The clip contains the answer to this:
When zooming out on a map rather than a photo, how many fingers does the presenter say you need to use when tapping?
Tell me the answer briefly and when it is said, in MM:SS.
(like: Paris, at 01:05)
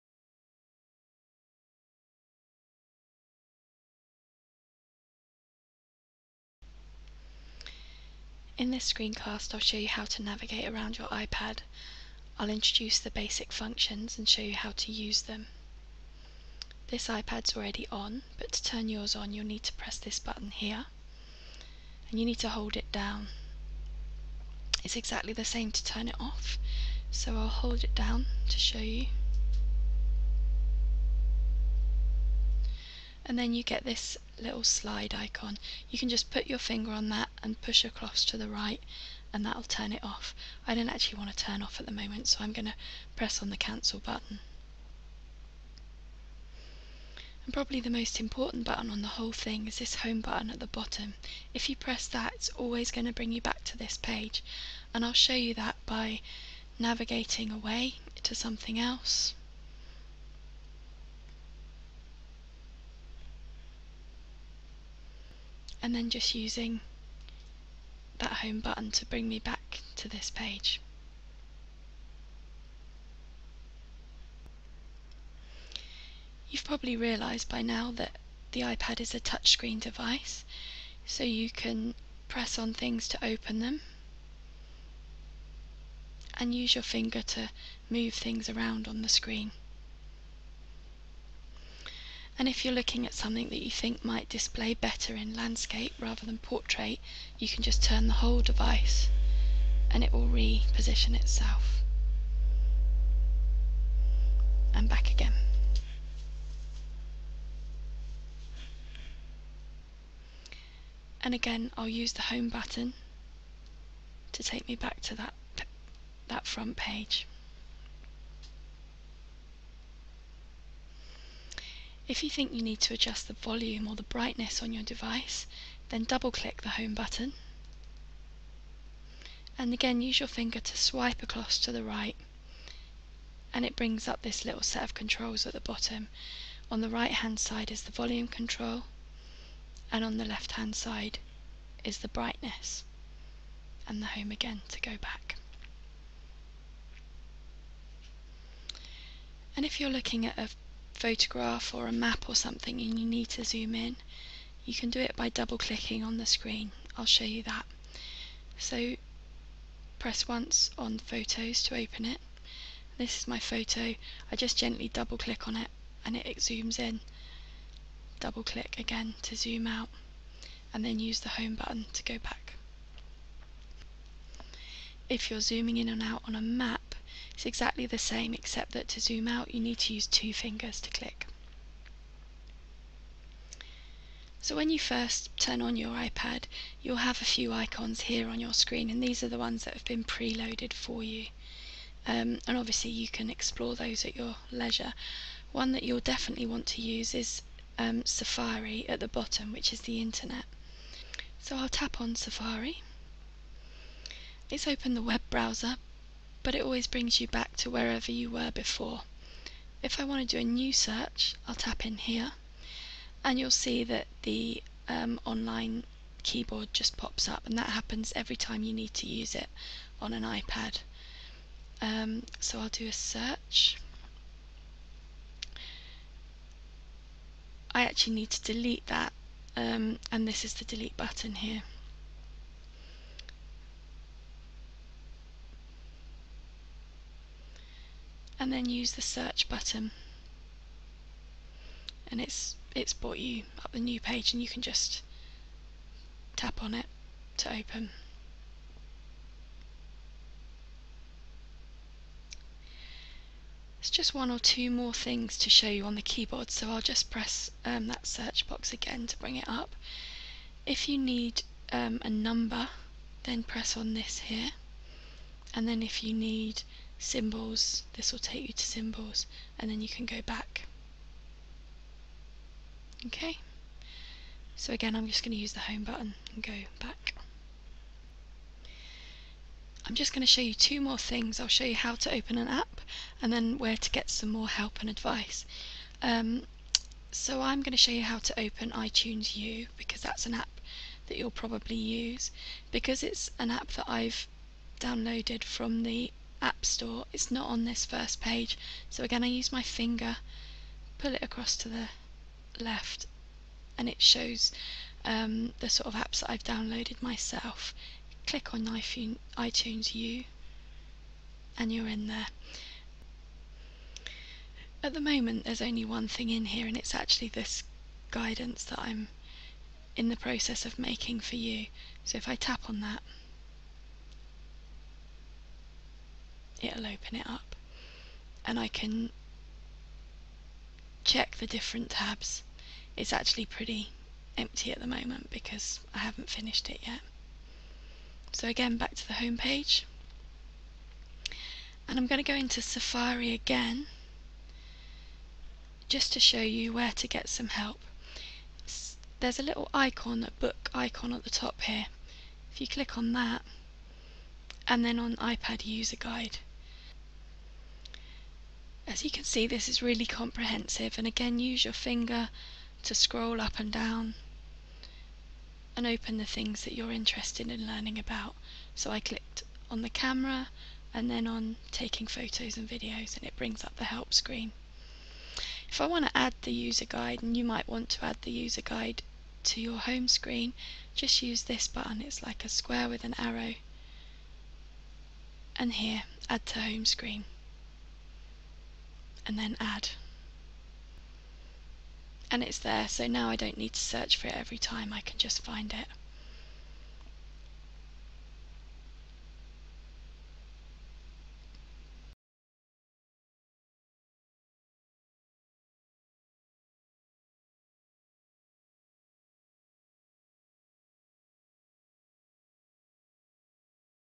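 2, at 03:00.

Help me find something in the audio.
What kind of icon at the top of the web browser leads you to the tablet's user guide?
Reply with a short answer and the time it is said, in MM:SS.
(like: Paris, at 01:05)
Book icon, at 05:50.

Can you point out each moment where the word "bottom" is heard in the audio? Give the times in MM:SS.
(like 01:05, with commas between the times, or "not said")
00:50, 02:15, 03:19.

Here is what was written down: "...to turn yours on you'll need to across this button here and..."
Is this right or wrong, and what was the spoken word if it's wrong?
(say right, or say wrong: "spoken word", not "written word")
wrong: "press", not "across".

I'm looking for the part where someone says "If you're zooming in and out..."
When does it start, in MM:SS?
02:55.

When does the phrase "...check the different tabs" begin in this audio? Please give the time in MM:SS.
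05:31.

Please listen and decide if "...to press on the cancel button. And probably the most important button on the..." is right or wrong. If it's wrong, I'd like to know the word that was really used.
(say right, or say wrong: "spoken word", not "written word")
right.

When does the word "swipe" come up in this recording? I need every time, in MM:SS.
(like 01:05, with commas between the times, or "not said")
02:10.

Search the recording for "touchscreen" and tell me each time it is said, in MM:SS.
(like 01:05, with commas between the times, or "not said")
01:19.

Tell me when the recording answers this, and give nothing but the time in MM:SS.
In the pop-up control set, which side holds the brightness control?
02:20.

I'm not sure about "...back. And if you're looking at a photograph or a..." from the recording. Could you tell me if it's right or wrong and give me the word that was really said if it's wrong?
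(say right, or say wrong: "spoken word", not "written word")
right.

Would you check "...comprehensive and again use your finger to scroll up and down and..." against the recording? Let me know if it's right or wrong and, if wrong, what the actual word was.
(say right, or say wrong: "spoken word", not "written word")
right.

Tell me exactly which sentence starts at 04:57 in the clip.
It's not on this first page.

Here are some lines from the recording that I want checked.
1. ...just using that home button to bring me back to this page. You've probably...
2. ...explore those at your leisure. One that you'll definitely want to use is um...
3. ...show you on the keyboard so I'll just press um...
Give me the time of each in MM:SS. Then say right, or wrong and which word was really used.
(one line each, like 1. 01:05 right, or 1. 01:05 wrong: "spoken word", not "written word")
1. 01:06 right
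2. 03:13 right
3. 04:15 right.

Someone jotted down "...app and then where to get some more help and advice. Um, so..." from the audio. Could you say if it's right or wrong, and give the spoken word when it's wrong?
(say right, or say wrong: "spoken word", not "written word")
right.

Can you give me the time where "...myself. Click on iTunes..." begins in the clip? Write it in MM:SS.
05:06.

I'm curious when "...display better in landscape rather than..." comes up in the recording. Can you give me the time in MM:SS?
01:34.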